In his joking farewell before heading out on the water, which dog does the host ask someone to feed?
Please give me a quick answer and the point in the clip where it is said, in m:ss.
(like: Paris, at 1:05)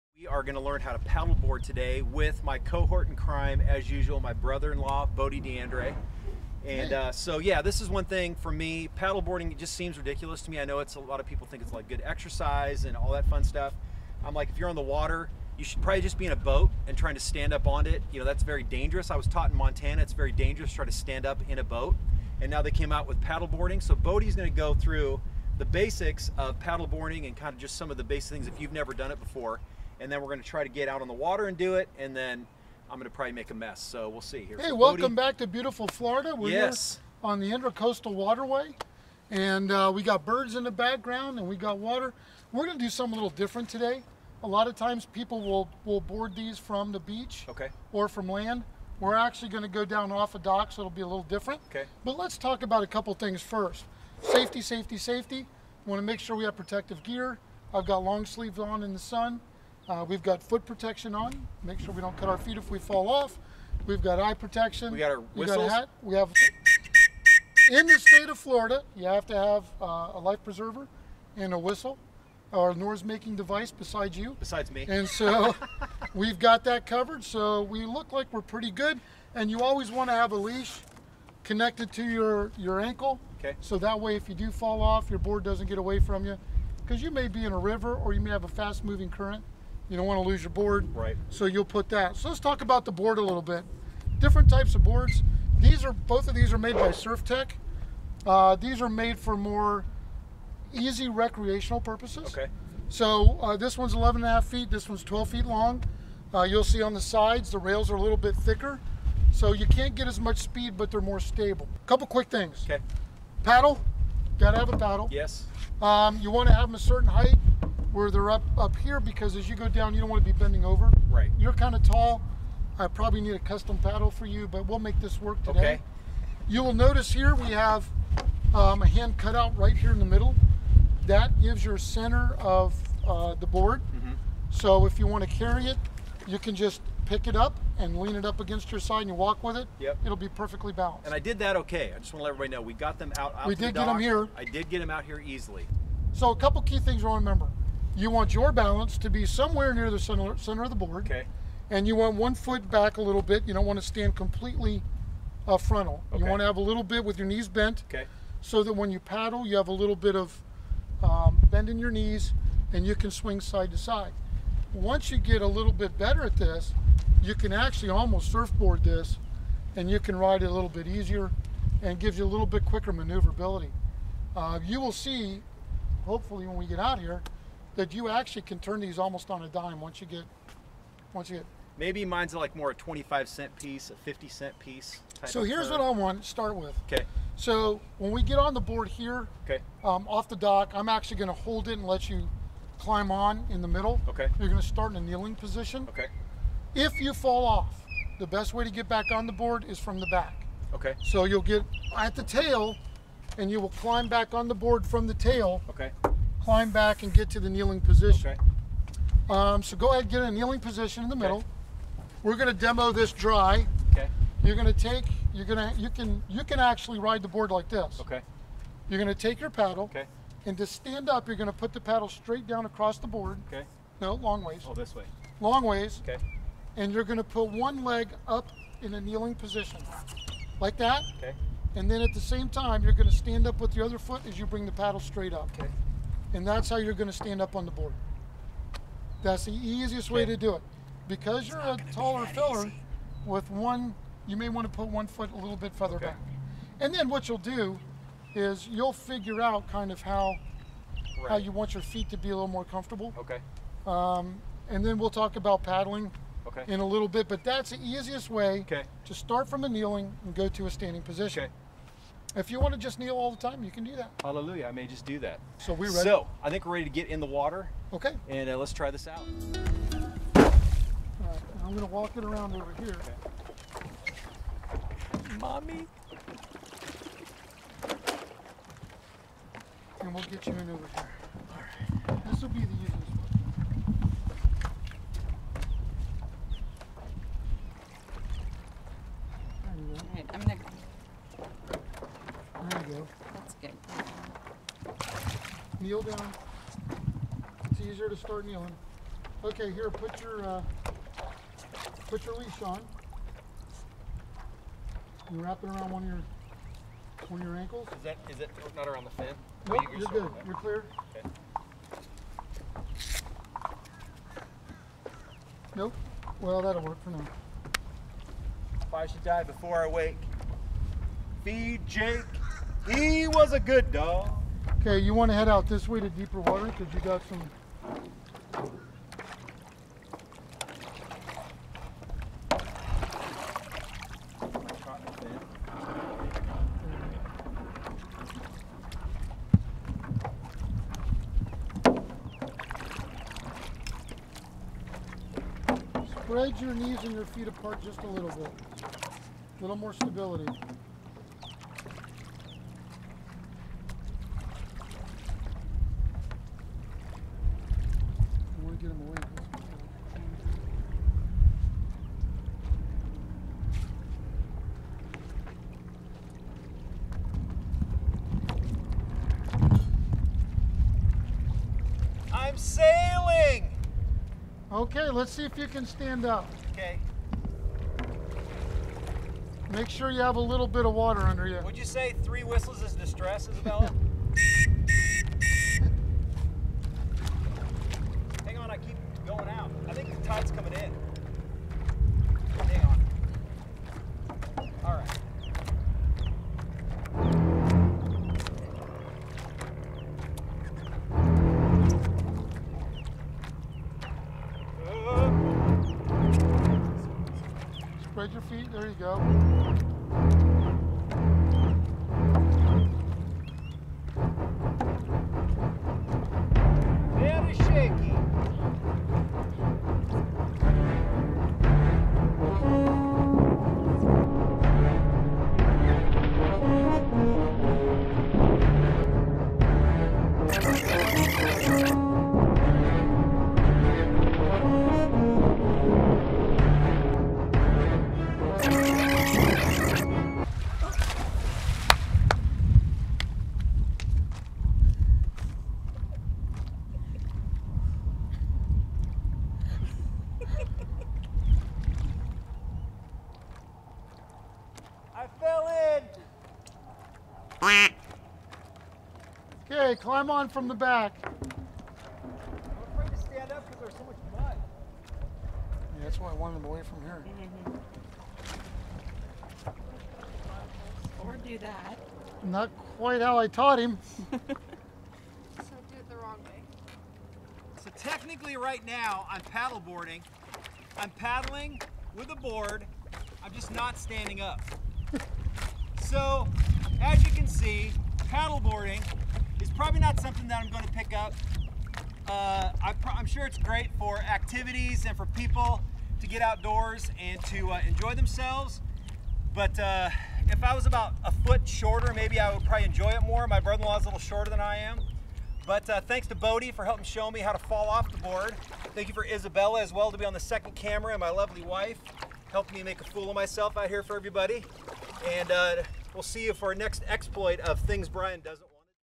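Jake, at 5:21.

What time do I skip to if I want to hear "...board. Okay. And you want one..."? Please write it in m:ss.
2:30.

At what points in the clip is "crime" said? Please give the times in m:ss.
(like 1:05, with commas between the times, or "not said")
0:03.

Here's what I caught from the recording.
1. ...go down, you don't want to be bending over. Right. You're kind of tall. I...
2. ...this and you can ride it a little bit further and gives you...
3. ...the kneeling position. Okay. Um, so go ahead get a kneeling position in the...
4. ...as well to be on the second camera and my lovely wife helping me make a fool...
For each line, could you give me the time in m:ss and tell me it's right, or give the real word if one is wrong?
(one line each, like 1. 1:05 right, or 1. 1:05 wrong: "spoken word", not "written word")
1. 1:59 right
2. 2:48 wrong: "easier", not "further"
3. 3:27 right
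4. 8:29 right.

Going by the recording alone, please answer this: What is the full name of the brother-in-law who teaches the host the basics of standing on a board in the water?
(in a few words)
Bodie DeAndre.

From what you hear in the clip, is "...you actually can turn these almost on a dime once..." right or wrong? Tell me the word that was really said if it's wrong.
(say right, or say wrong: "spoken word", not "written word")
right.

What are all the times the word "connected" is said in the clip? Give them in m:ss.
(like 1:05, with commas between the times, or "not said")
1:21.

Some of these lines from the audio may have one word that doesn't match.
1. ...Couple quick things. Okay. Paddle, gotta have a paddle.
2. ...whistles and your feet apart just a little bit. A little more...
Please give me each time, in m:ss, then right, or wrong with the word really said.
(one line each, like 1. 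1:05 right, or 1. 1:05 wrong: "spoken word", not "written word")
1. 1:51 right
2. 5:46 wrong: "knees", not "whistles".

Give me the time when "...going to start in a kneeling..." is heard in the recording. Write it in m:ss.
3:14.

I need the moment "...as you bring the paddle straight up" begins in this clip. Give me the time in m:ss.
3:54.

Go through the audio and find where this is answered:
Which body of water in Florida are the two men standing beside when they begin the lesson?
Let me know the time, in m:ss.
0:37.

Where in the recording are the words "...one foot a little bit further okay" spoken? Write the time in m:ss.
4:04.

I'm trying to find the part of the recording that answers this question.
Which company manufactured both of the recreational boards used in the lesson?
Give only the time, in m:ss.
1:36.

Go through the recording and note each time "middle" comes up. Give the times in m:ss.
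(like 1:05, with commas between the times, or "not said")
2:10, 3:13, 3:31.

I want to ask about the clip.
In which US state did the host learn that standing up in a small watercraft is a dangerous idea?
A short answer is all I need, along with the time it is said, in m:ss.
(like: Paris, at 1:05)
Montana, at 0:19.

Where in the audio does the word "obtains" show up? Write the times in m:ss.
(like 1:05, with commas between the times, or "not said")
not said.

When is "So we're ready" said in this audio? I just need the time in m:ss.
4:25.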